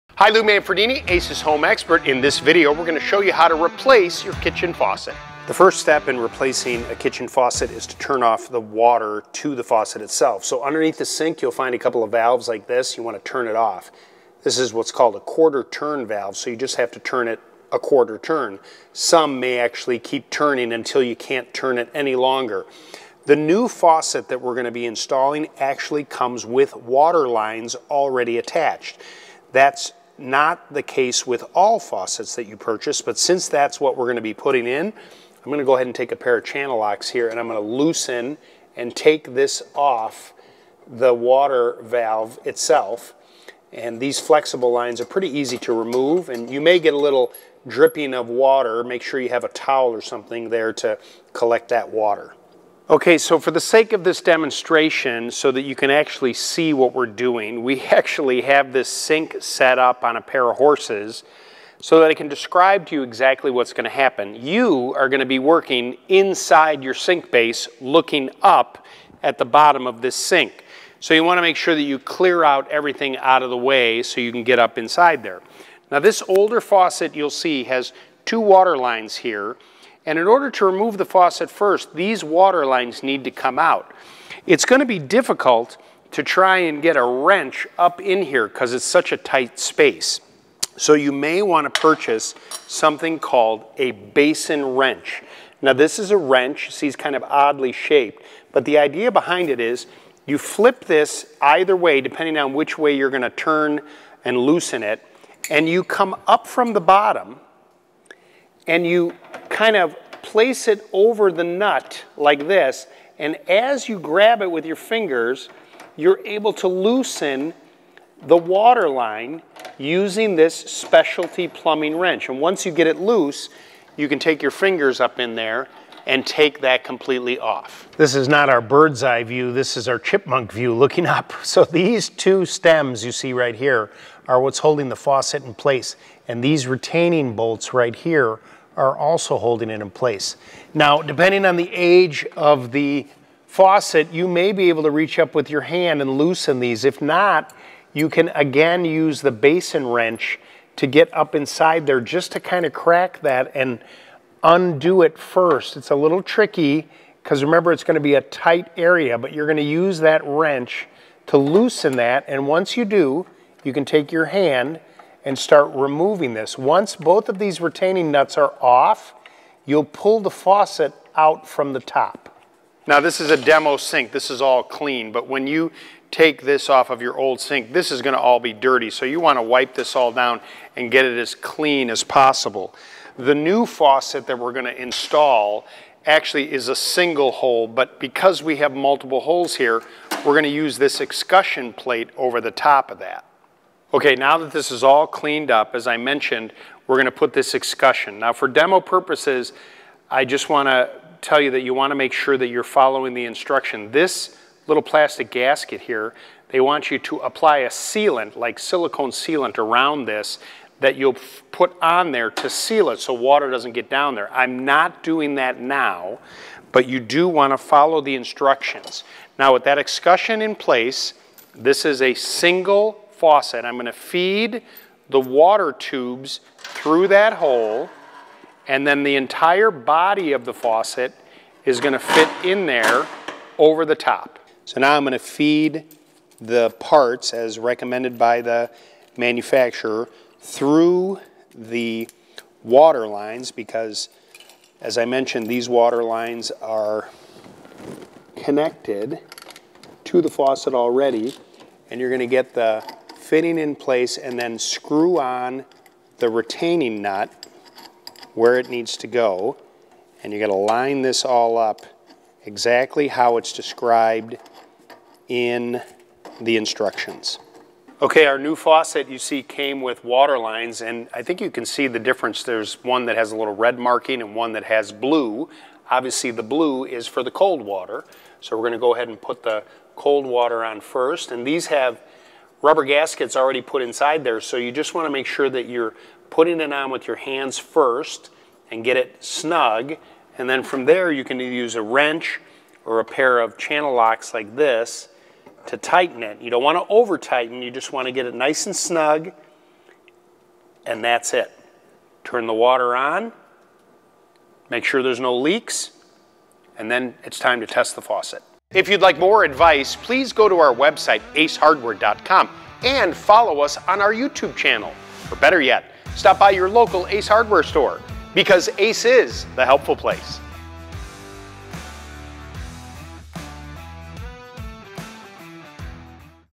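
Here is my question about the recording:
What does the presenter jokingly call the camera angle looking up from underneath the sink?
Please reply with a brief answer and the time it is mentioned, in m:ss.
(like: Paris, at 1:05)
chipmunk view, at 2:09.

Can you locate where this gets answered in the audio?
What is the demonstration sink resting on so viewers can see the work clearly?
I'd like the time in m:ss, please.
1:00.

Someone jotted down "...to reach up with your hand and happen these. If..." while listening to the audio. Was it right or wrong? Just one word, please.
wrong.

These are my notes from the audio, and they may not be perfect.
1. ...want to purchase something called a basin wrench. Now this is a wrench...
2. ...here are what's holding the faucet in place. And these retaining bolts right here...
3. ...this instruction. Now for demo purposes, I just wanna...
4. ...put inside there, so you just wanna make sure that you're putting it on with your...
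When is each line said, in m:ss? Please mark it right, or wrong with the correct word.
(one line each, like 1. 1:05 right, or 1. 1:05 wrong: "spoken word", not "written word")
1. 1:31 right
2. 2:13 right
3. 3:17 wrong: "escutcheon", not "instruction"
4. 4:43 right.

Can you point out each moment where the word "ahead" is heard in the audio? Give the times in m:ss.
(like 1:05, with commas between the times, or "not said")
0:35, 4:38.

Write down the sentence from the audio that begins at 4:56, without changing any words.
You don't wanna over tighten, you just wanna get it nice and snug, and that's it.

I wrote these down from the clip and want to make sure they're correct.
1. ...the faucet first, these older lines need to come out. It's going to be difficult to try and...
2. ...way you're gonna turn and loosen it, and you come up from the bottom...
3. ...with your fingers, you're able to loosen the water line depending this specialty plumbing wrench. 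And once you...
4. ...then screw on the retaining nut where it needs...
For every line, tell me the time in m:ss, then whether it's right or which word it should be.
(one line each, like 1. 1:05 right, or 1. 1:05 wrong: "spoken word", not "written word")
1. 1:20 wrong: "water", not "older"
2. 1:42 right
3. 1:54 wrong: "using", not "depending"
4. 4:14 right.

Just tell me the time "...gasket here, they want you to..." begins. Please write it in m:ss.
3:25.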